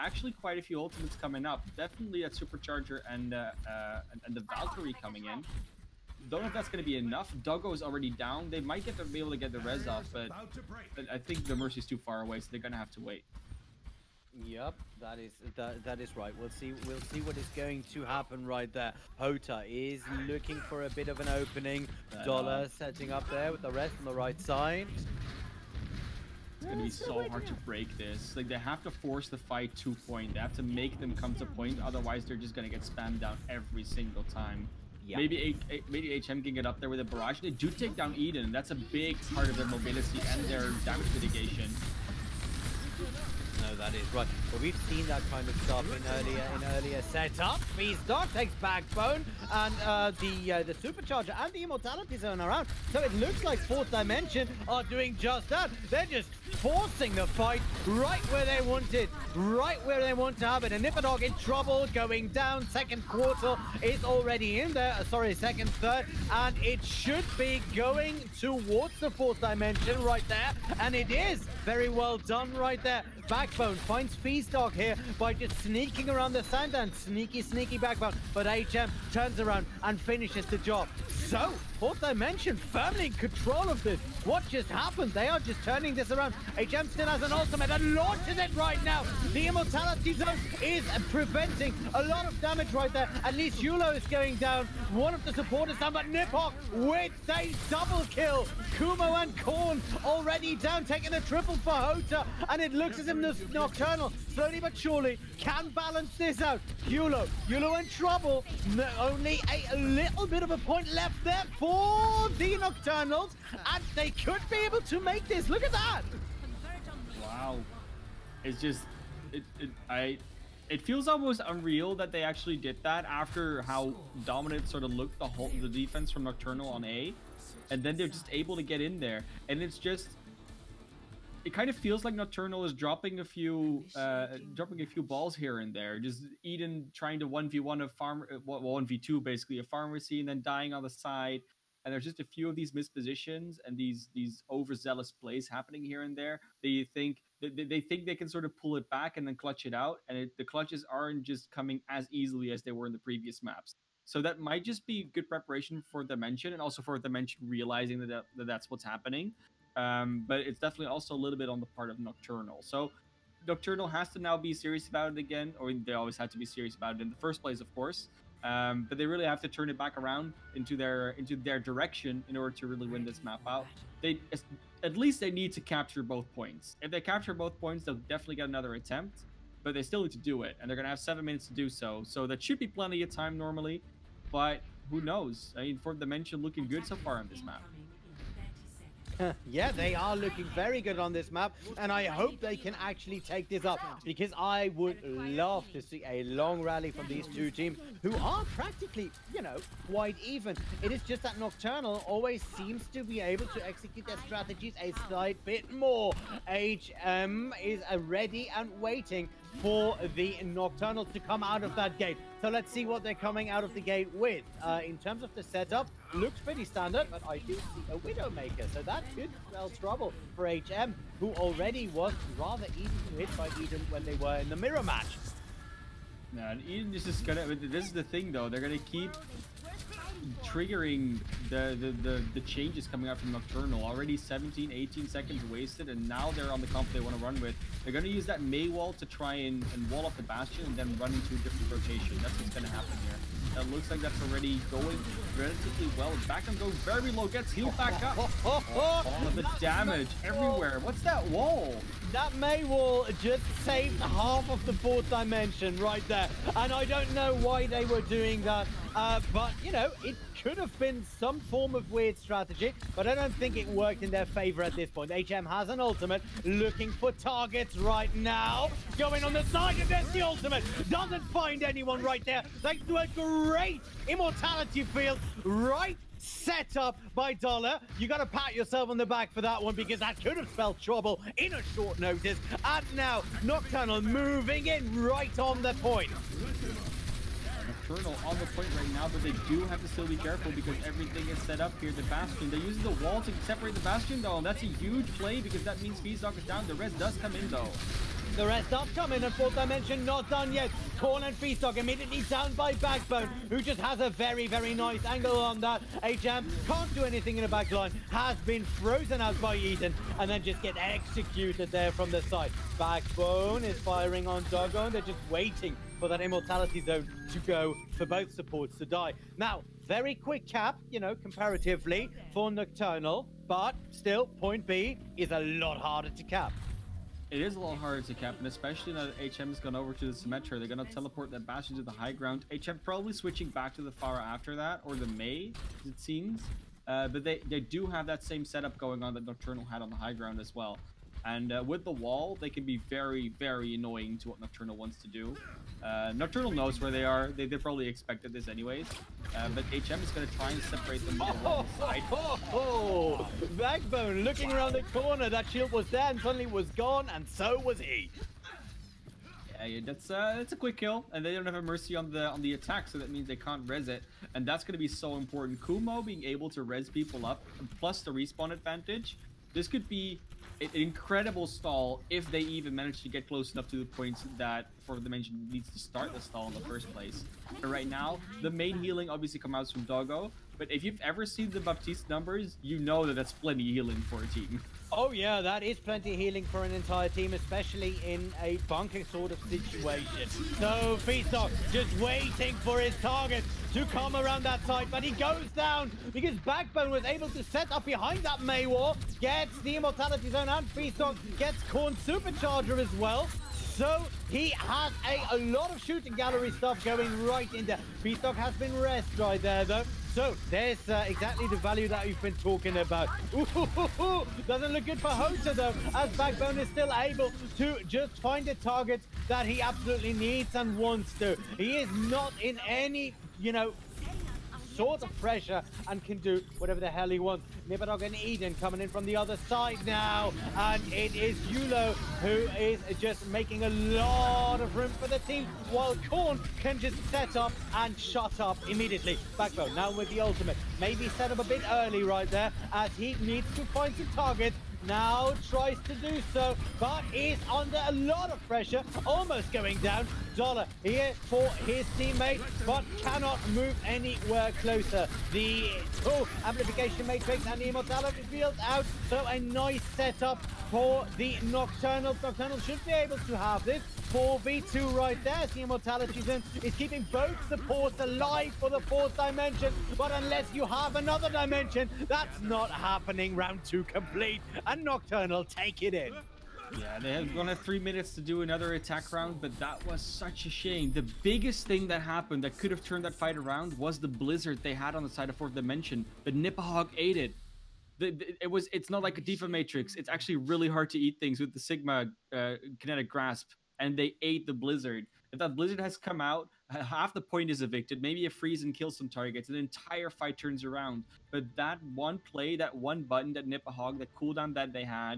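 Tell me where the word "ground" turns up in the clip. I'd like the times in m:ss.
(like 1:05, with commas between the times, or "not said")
5:32, 5:40.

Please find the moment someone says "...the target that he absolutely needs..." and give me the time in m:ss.
6:58.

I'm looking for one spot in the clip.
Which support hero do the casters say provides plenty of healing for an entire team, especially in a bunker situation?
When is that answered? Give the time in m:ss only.
6:21.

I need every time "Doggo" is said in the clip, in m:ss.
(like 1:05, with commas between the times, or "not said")
0:07, 6:19.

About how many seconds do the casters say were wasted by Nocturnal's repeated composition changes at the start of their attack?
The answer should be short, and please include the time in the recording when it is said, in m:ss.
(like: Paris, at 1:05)
17, 18 seconds, at 3:54.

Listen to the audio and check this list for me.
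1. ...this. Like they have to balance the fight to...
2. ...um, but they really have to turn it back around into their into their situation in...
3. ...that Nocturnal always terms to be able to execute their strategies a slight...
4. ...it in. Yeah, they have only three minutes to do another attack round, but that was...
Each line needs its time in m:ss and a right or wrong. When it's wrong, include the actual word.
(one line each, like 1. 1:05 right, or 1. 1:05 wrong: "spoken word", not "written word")
1. 0:27 wrong: "force", not "balance"
2. 2:48 wrong: "direction", not "situation"
3. 3:21 wrong: "seems", not "terms"
4. 7:55 right.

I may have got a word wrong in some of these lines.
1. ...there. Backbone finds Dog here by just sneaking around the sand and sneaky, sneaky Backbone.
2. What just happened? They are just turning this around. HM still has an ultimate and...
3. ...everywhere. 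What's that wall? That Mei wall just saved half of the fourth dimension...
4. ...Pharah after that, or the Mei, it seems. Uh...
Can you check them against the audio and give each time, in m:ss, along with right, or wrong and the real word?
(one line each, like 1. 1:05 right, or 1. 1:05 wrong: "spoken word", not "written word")
1. 1:12 right
2. 1:24 right
3. 4:10 right
4. 5:33 right.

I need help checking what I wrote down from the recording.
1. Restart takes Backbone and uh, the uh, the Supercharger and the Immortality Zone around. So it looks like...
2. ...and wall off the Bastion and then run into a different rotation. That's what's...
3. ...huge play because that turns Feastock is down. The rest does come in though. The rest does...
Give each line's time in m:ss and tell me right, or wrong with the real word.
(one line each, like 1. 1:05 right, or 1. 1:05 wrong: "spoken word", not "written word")
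1. 0:47 right
2. 3:59 right
3. 4:54 wrong: "means", not "turns".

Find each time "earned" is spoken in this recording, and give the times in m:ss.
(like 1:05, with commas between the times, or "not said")
not said.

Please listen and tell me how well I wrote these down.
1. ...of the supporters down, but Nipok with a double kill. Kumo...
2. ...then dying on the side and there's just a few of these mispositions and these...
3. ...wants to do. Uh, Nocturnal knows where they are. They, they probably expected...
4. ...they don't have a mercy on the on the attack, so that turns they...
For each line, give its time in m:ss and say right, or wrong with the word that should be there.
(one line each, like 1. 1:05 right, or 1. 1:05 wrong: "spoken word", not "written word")
1. 1:35 right
2. 2:20 right
3. 5:44 right
4. 6:01 wrong: "means", not "turns".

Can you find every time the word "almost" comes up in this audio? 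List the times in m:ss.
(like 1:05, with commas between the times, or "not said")
2:01, 7:29.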